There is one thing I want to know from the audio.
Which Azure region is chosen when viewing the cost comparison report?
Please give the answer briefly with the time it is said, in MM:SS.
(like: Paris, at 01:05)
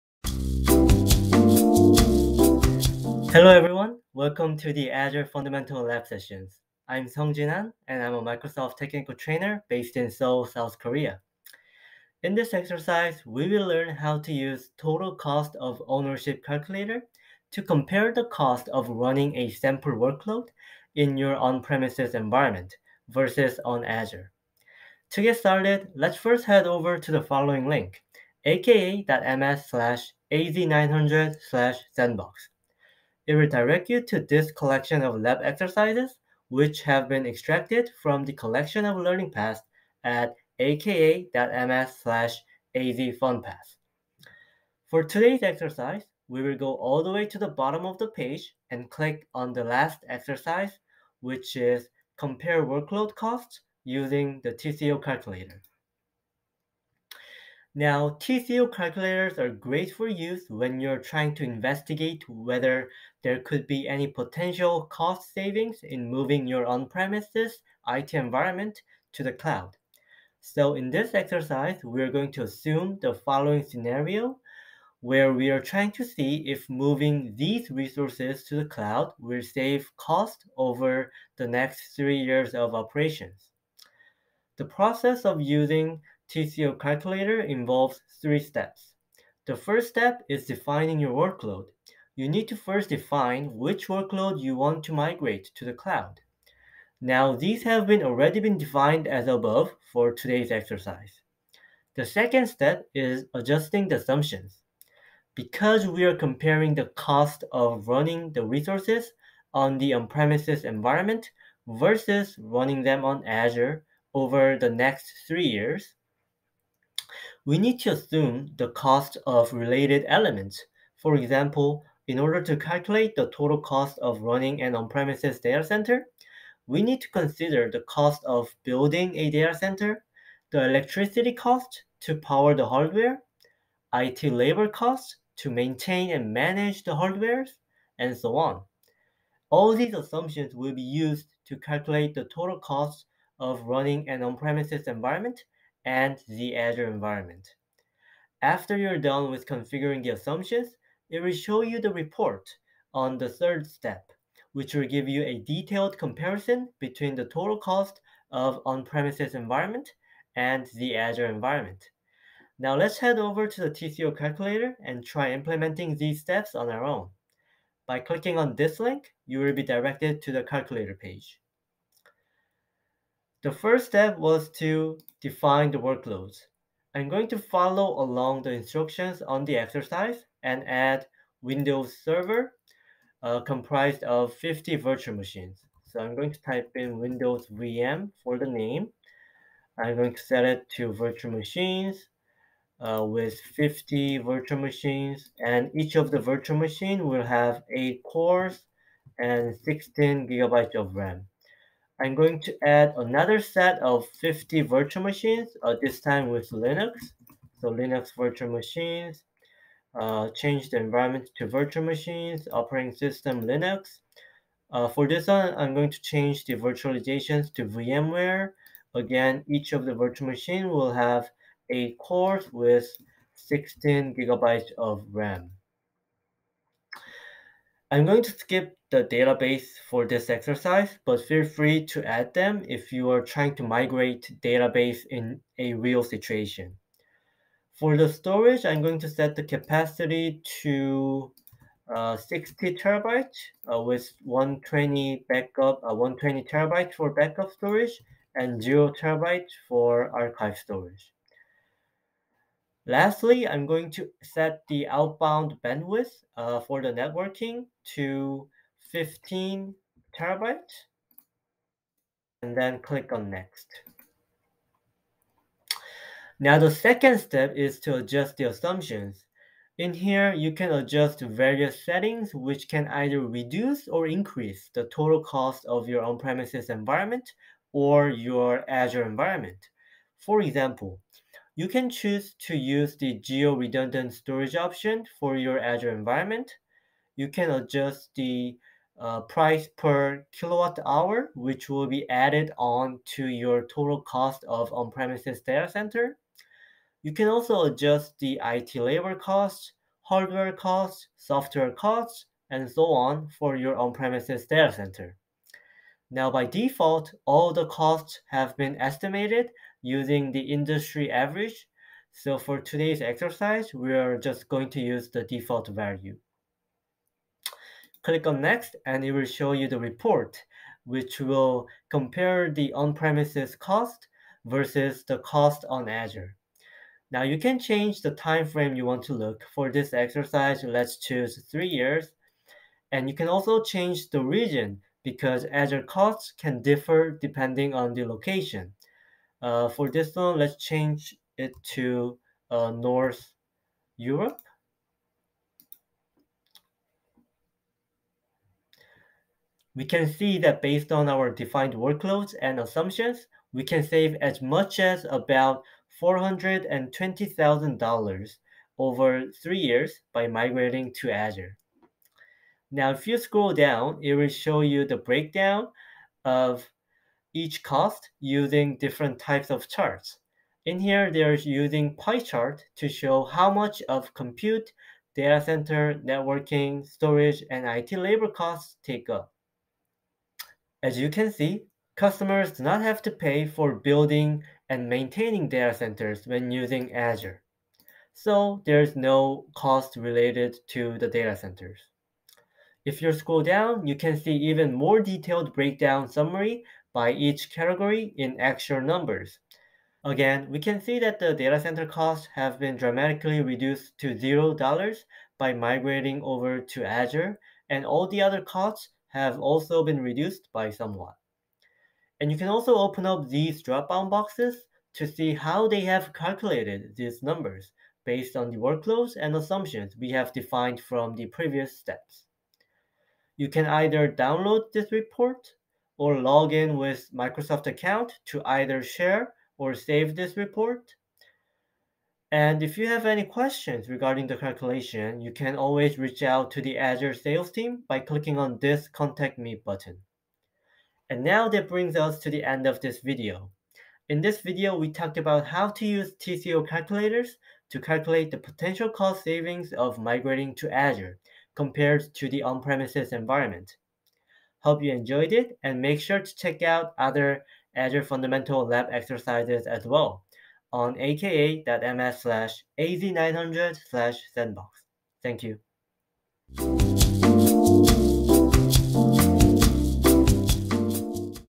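North Europe, at 05:42.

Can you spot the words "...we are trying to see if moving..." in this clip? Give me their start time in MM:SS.
01:15.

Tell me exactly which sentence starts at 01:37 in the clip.
Now these have been already been defined as above for today's exercise.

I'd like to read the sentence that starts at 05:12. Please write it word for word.
So for today's exercise, we are just going to use the default value.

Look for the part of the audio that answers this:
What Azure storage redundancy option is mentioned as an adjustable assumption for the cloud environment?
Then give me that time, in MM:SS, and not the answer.
04:43.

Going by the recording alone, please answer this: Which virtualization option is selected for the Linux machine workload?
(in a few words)
VMware.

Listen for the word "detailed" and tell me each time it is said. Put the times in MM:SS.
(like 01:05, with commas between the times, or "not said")
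02:35, 06:35.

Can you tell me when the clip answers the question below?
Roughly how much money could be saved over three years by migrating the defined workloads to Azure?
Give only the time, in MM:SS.
05:56.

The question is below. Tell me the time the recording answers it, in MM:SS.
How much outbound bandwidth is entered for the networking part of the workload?
04:18.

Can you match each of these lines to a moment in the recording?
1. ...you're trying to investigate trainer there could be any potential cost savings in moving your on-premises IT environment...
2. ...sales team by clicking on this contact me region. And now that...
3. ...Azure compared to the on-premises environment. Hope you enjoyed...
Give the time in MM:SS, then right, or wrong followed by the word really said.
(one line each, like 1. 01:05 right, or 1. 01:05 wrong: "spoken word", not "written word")
1. 01:00 wrong: "whether", not "trainer"
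2. 07:17 wrong: "button", not "region"
3. 07:30 right.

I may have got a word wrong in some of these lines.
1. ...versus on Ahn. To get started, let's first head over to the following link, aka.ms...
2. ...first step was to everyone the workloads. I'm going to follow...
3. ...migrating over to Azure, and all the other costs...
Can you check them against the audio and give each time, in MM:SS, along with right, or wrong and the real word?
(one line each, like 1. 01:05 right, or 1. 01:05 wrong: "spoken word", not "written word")
1. 00:23 wrong: "Azure", not "Ahn"
2. 02:53 wrong: "define", not "everyone"
3. 06:45 right.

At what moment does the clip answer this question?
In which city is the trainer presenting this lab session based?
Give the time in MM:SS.
00:10.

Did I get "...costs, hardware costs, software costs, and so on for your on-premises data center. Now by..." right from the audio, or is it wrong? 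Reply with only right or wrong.
right.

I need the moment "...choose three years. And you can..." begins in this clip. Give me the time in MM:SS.
05:30.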